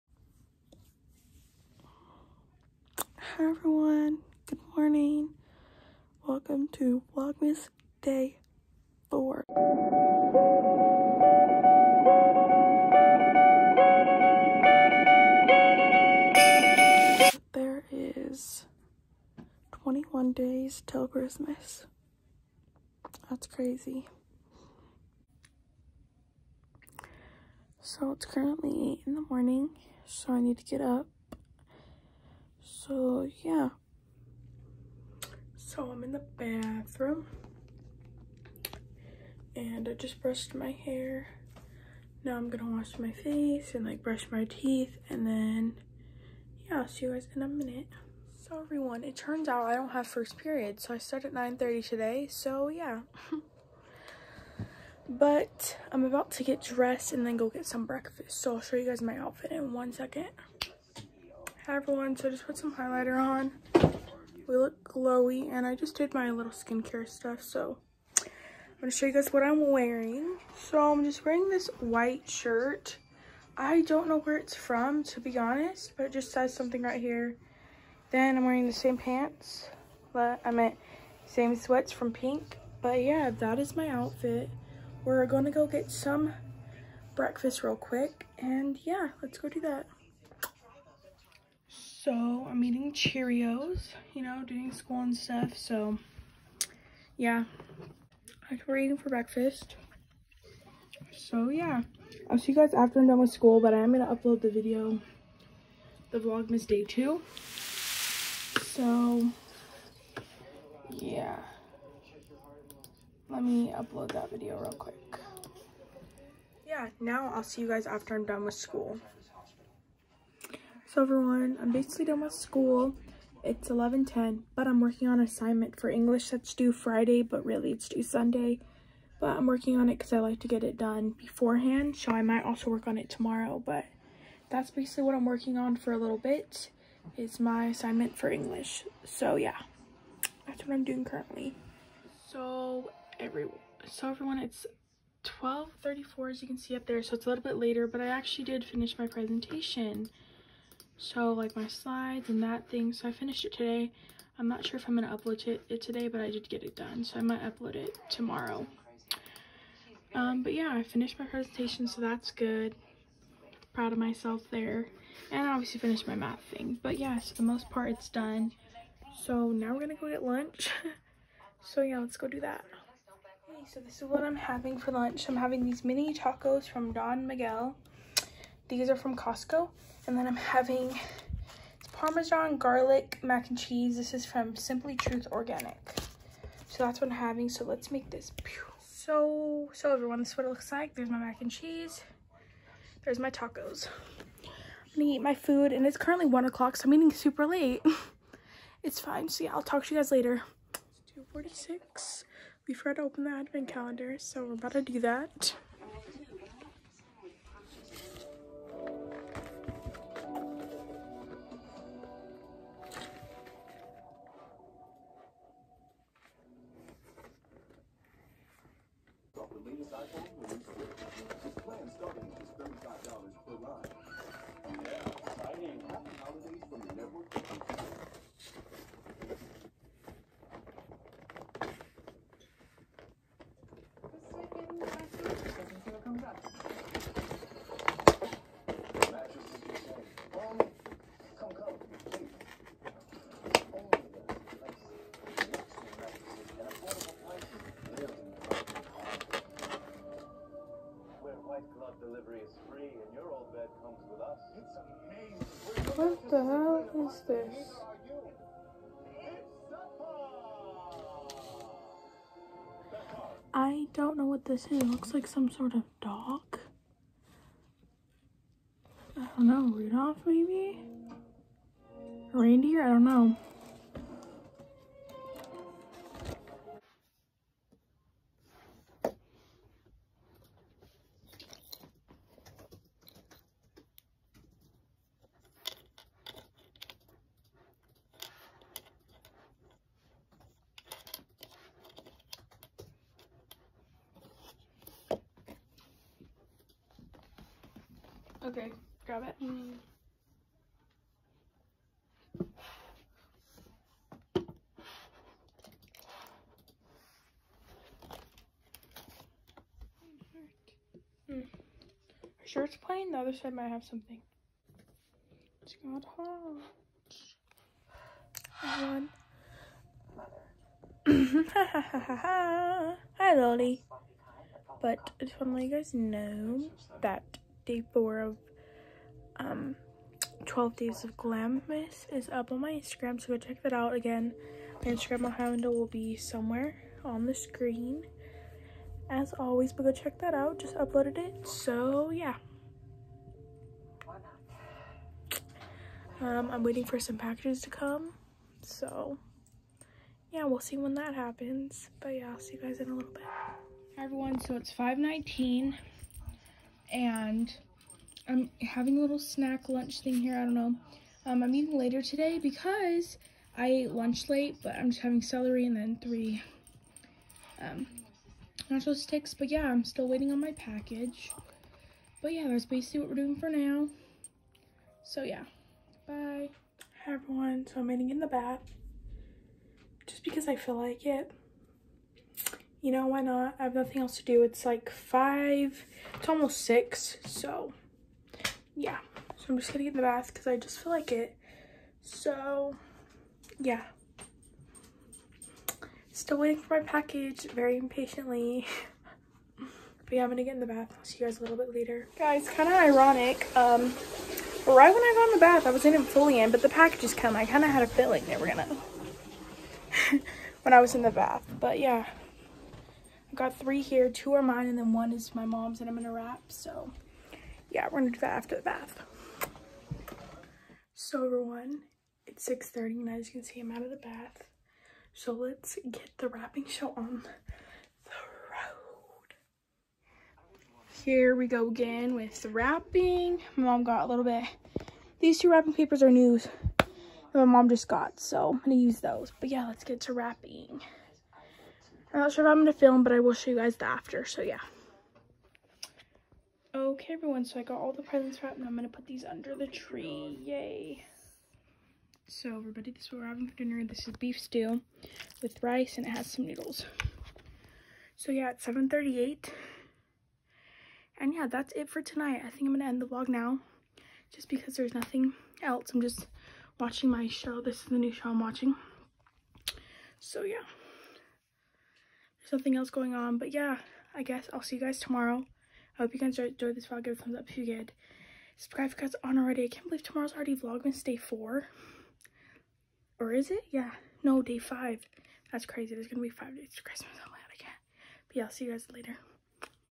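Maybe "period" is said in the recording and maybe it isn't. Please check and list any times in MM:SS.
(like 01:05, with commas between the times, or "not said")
00:50.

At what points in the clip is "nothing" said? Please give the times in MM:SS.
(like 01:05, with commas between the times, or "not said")
06:23, 07:44.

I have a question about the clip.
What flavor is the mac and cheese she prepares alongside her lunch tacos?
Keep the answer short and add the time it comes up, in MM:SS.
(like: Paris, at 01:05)
Parmesan garlic, at 03:01.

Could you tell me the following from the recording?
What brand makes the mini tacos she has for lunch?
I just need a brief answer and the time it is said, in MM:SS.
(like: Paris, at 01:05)
Don Miguel, at 02:56.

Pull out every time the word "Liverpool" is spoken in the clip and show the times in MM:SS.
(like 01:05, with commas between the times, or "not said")
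not said.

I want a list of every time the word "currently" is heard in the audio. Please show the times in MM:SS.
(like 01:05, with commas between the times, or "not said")
00:28, 02:21, 03:15.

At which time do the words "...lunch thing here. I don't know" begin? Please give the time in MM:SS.
05:59.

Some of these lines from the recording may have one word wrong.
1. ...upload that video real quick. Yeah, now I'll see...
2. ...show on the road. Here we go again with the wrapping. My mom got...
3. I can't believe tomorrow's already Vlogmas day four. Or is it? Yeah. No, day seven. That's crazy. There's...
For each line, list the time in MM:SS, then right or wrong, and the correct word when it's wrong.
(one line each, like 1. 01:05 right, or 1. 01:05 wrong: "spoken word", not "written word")
1. 01:53 right
2. 07:06 right
3. 07:59 wrong: "five", not "seven".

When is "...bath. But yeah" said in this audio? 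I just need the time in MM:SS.
06:51.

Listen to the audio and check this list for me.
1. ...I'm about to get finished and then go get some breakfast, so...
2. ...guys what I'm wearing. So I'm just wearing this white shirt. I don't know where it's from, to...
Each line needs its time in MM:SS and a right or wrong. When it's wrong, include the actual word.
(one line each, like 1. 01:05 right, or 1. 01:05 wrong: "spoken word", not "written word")
1. 00:55 wrong: "dressed", not "finished"
2. 01:09 right.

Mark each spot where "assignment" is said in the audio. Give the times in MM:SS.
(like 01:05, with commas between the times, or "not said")
02:05, 02:17.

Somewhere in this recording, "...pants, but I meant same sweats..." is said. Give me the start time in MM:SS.
01:18.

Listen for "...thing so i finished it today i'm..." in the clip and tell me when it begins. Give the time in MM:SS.
02:32.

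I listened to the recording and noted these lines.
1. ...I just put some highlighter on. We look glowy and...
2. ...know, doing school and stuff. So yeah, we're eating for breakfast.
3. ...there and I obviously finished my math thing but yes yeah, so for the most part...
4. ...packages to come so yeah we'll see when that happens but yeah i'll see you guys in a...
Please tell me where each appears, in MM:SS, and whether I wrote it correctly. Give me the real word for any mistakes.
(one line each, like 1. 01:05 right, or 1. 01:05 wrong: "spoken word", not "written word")
1. 01:02 right
2. 01:34 right
3. 02:44 right
4. 05:47 right.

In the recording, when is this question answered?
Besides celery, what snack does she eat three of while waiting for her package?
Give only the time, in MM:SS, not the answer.
06:08.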